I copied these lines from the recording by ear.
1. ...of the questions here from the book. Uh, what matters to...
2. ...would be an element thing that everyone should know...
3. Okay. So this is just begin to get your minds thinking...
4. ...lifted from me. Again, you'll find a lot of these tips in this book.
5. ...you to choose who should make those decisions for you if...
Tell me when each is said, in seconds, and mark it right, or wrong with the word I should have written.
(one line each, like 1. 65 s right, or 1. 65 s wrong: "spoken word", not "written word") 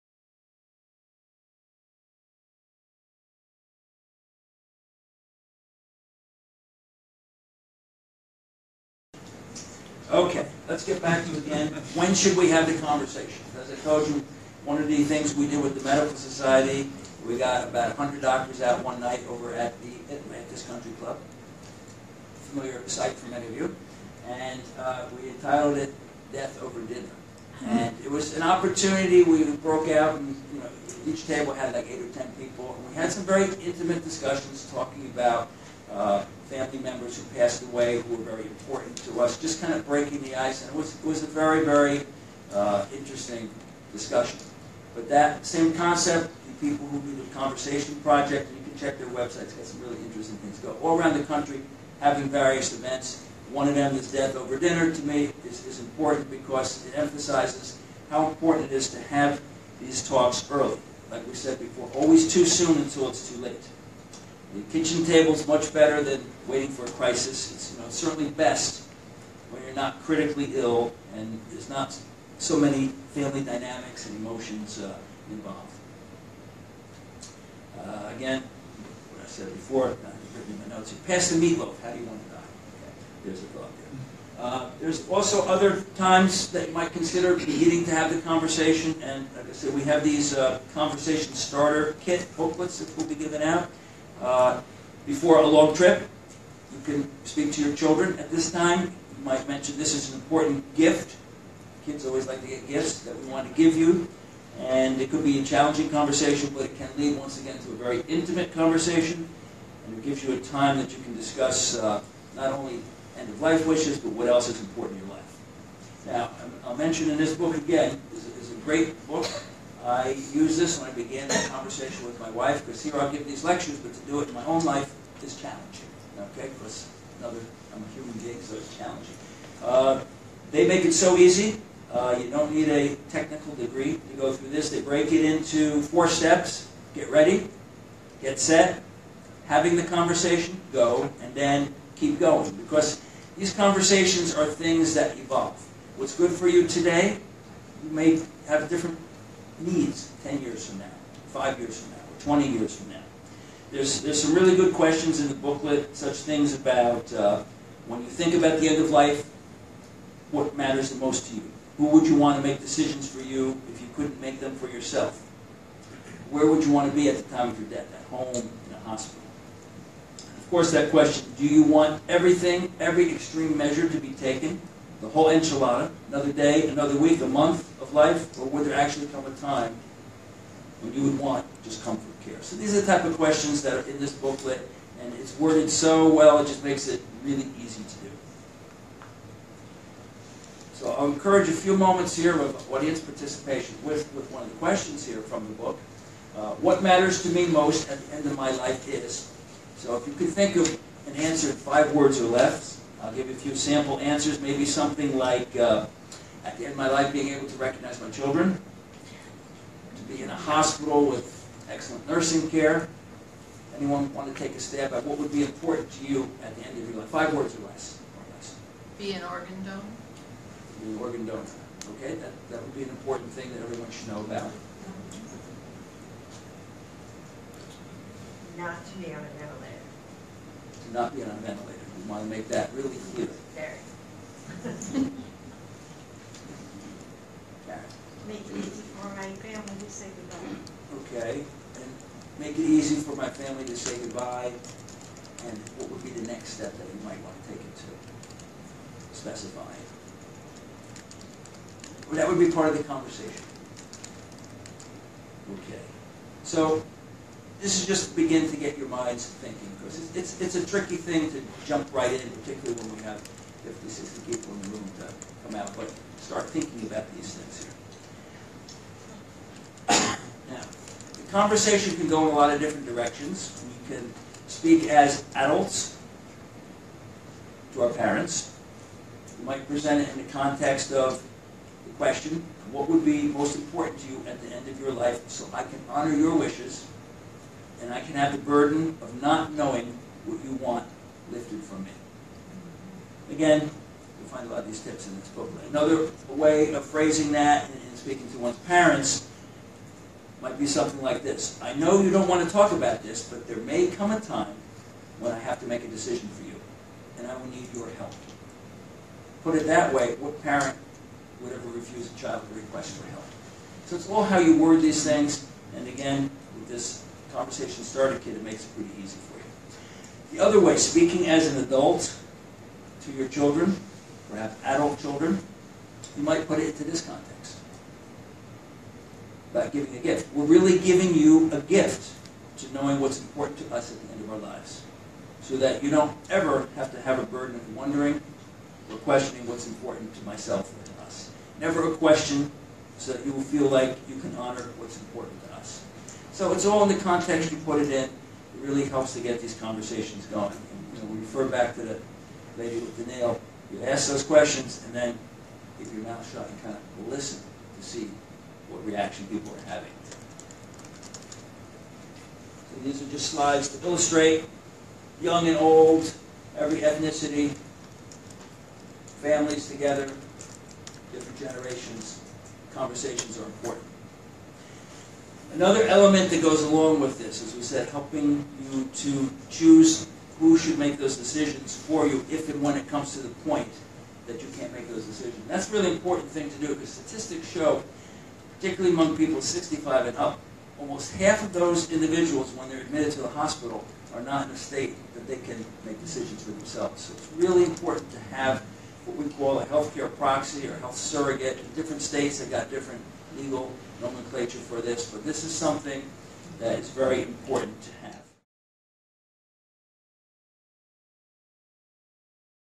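1. 194 s right
2. 222 s wrong: "important", not "element"
3. 255 s right
4. 291 s right
5. 378 s right.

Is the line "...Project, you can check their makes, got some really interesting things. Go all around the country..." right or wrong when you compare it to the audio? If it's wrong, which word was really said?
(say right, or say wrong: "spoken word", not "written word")
wrong: "websites", not "makes".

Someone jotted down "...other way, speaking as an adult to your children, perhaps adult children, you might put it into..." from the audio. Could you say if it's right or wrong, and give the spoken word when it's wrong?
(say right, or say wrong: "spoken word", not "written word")
right.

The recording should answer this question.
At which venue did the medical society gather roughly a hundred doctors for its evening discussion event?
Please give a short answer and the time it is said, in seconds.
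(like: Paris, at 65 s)
Atlantis Country Club, at 20 s.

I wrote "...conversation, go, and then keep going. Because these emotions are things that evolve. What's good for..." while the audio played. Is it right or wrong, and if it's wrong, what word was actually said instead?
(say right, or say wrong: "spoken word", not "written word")
wrong: "conversations", not "emotions".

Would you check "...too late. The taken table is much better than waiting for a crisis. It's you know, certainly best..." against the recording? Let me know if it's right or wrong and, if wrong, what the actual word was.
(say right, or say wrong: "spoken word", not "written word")
wrong: "kitchen", not "taken".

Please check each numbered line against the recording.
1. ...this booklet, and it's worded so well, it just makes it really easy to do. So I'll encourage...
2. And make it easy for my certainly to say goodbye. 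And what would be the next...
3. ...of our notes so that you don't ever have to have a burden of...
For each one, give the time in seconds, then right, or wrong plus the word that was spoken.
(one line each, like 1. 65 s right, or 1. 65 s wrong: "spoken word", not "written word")
1. 183 s right
2. 241 s wrong: "family", not "certainly"
3. 334 s wrong: "lives", not "notes".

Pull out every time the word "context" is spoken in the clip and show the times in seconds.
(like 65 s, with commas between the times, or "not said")
280 s, 327 s, 347 s.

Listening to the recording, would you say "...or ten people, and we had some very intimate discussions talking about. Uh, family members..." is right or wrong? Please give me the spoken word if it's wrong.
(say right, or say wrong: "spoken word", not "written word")
right.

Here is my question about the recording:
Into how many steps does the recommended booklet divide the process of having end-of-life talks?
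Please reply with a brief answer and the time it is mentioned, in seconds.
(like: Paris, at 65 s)
4, at 135 s.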